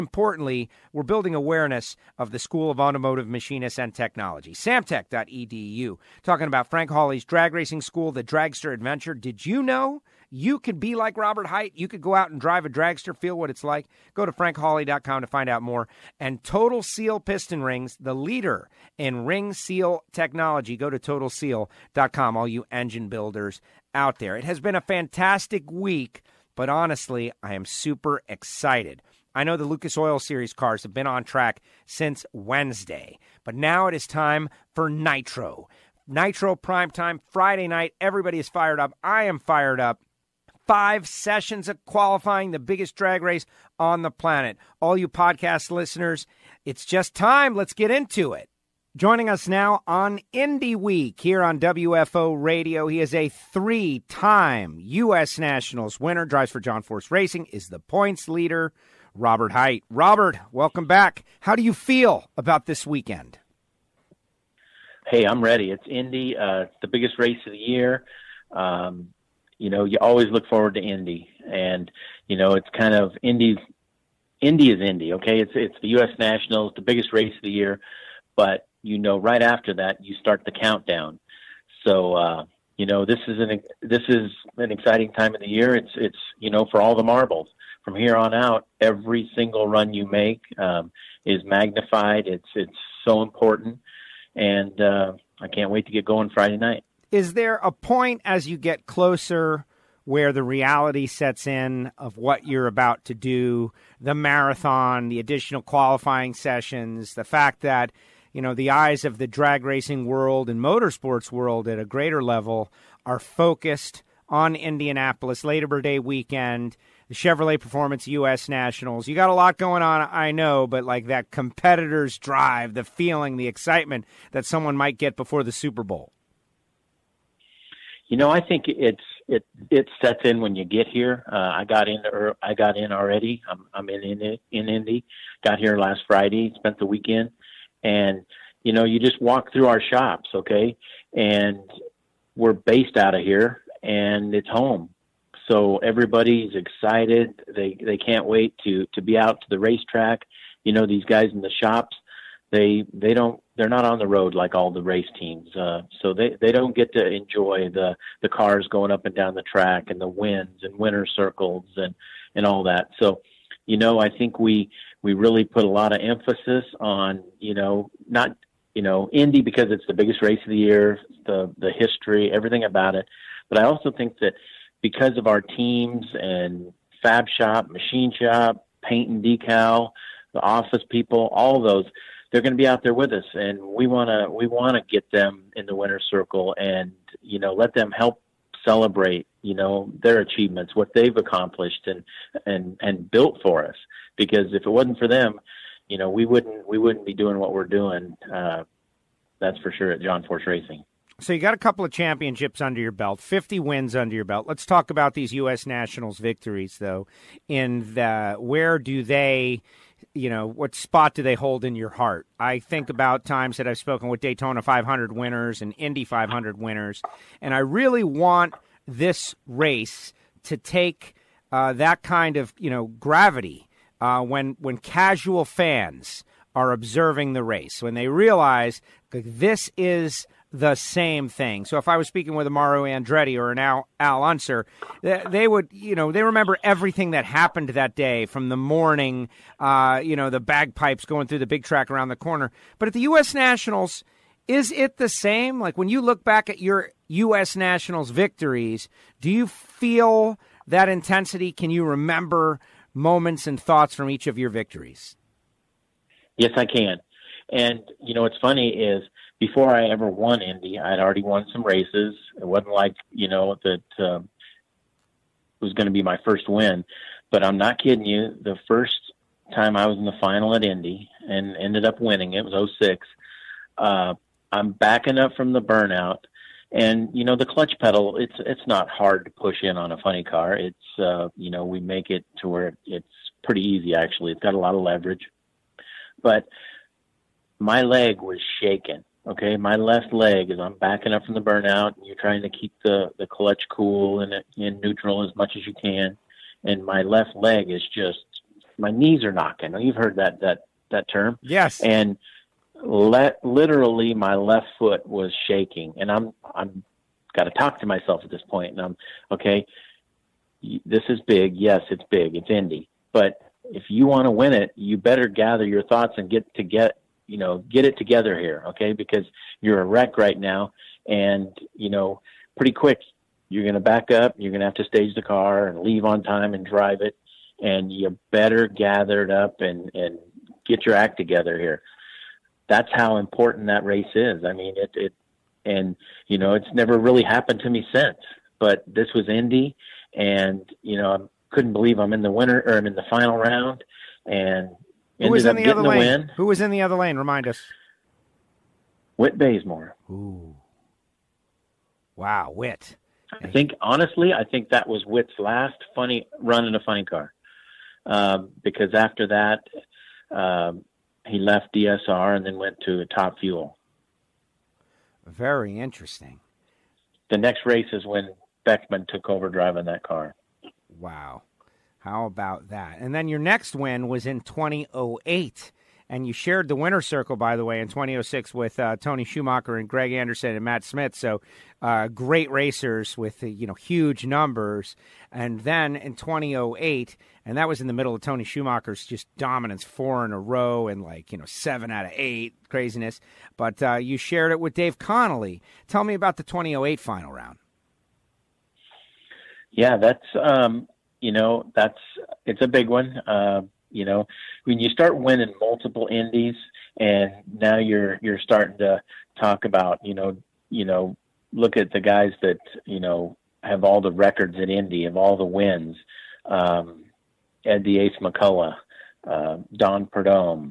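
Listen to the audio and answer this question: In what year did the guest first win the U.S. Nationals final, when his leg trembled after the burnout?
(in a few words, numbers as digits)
2006.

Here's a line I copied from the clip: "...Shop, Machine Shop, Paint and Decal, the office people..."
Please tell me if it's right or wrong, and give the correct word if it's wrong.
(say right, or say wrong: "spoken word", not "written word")
right.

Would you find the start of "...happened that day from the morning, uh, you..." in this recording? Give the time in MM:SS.
03:57.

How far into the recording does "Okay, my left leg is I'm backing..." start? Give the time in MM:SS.
04:49.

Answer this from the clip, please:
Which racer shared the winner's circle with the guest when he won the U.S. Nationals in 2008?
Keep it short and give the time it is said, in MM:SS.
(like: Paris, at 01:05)
Dave Connolly, at 06:34.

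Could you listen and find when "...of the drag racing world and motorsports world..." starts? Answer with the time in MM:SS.
01:49.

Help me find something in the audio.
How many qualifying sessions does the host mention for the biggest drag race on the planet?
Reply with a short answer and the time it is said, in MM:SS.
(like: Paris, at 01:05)
5, at 00:40.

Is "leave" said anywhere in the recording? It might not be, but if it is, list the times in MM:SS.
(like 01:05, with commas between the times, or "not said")
05:25.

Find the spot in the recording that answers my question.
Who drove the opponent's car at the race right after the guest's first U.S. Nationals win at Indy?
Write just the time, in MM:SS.
06:08.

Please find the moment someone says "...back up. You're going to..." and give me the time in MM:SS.
05:23.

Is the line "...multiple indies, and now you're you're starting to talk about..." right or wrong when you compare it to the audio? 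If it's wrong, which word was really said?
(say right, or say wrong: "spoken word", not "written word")
right.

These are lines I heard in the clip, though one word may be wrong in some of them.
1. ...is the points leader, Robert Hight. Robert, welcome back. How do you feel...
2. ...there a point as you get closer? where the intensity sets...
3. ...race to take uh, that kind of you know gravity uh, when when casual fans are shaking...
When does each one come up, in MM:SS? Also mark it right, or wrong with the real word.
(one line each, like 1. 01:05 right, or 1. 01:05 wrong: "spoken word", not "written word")
1. 00:57 right
2. 01:37 wrong: "reality", not "intensity"
3. 03:39 wrong: "observing", not "shaking".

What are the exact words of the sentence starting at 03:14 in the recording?
Because if it wasn't for them, you know, we wouldn't, we wouldn't be doing what we're doing.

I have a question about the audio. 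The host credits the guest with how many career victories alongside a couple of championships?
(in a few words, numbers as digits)
50.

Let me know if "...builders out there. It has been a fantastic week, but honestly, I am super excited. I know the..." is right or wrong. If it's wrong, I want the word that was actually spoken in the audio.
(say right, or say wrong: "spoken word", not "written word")
right.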